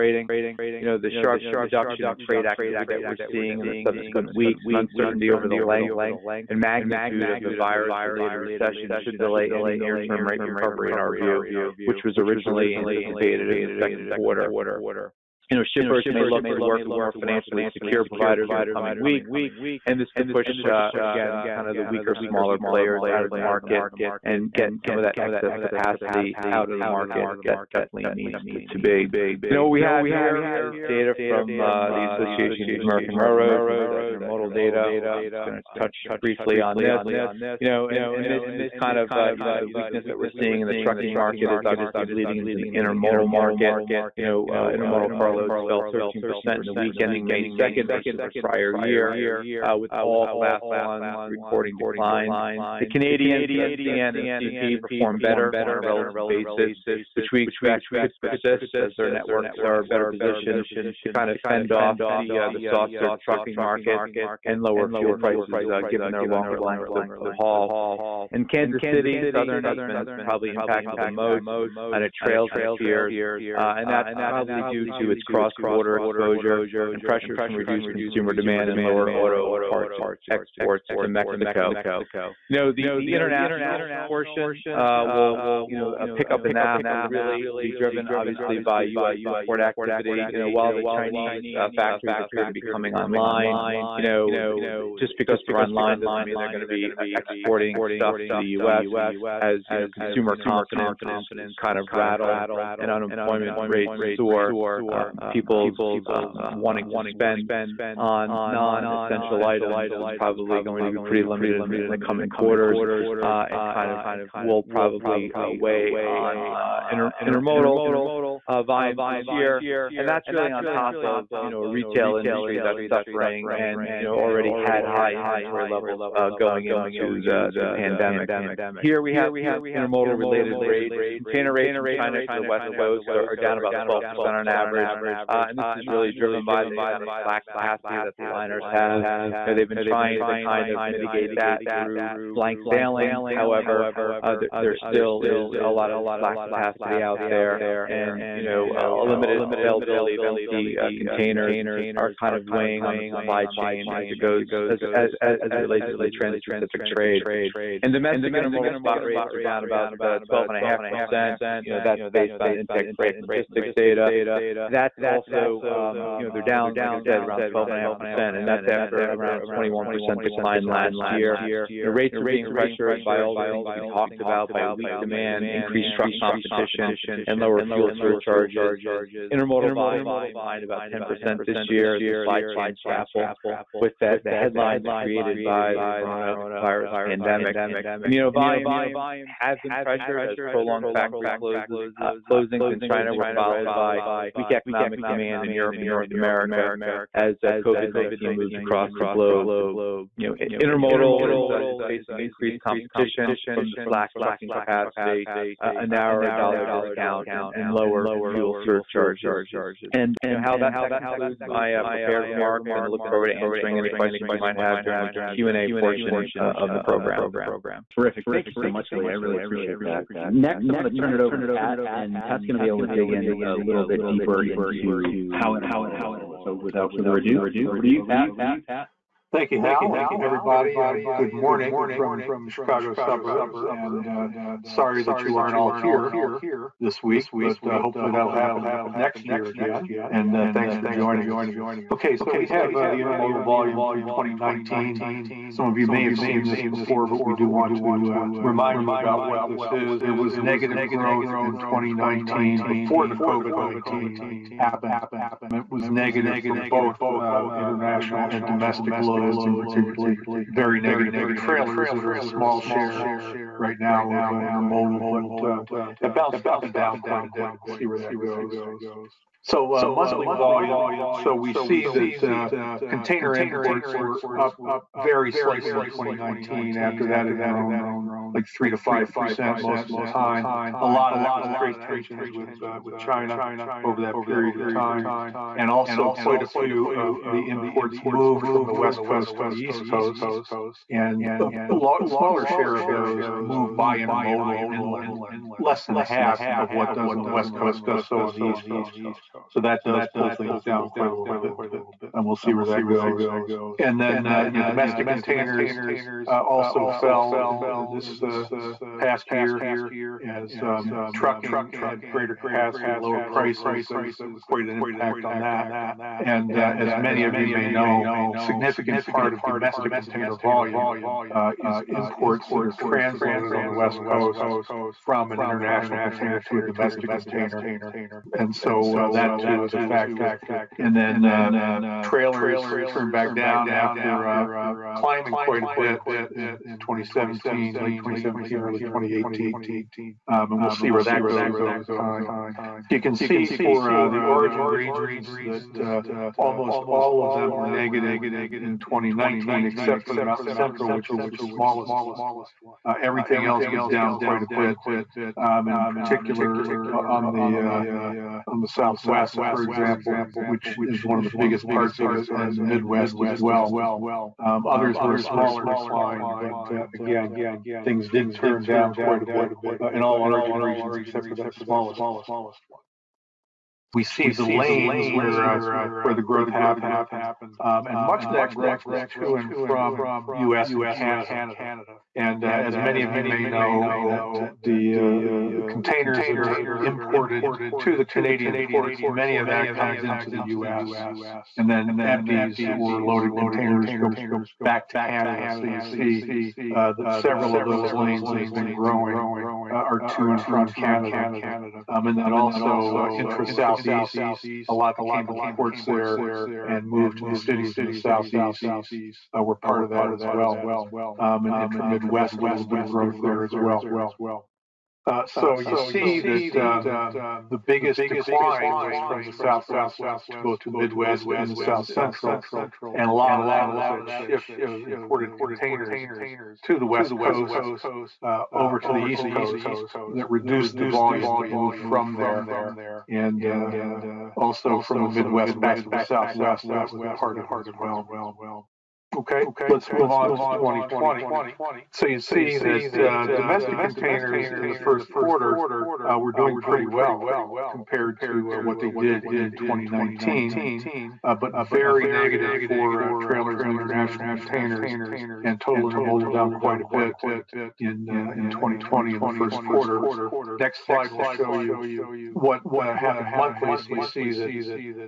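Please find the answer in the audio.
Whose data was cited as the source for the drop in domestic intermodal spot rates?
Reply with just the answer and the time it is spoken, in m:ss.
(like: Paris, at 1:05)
Intech Freight Logistics, at 2:42.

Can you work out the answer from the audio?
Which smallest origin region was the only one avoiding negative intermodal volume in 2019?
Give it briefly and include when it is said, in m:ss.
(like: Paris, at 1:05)
Mountain Central, at 5:50.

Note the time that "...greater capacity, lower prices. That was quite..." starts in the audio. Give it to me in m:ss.
5:12.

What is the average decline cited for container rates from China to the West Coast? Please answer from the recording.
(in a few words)
12%.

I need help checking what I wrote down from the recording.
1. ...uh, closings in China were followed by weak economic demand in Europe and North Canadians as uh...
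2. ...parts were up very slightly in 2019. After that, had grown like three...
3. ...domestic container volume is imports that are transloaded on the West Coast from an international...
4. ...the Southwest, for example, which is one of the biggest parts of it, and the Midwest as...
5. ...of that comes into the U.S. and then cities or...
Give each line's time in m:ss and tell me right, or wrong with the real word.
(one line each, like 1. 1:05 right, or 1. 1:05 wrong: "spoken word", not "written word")
1. 3:11 wrong: "America", not "Canadians"
2. 4:33 wrong: "imports", not "parts"
3. 5:19 right
4. 5:58 right
5. 6:29 wrong: "empties", not "cities".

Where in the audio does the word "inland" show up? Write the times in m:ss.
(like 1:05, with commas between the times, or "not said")
4:54.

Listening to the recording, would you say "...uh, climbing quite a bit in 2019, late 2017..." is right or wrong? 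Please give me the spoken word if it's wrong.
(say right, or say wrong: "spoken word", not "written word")
wrong: "2017", not "2019".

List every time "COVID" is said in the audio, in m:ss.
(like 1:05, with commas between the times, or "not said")
3:17, 4:13.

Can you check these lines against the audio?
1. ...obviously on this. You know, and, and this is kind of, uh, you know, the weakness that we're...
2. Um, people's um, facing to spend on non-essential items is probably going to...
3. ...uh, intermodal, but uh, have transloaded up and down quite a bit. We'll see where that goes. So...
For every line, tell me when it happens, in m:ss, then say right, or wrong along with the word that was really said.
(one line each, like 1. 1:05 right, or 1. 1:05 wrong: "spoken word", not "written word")
1. 0:36 wrong: "briefly", not "obviously"
2. 1:44 wrong: "wanting", not "facing"
3. 4:24 wrong: "bounced", not "transloaded".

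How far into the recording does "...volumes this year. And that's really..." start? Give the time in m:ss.
1:58.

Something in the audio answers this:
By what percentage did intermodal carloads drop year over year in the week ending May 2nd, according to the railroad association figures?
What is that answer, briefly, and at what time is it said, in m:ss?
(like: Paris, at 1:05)
13%, at 0:45.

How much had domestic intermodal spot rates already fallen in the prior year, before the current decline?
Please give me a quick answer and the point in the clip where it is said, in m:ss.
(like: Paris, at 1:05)
21%, at 2:49.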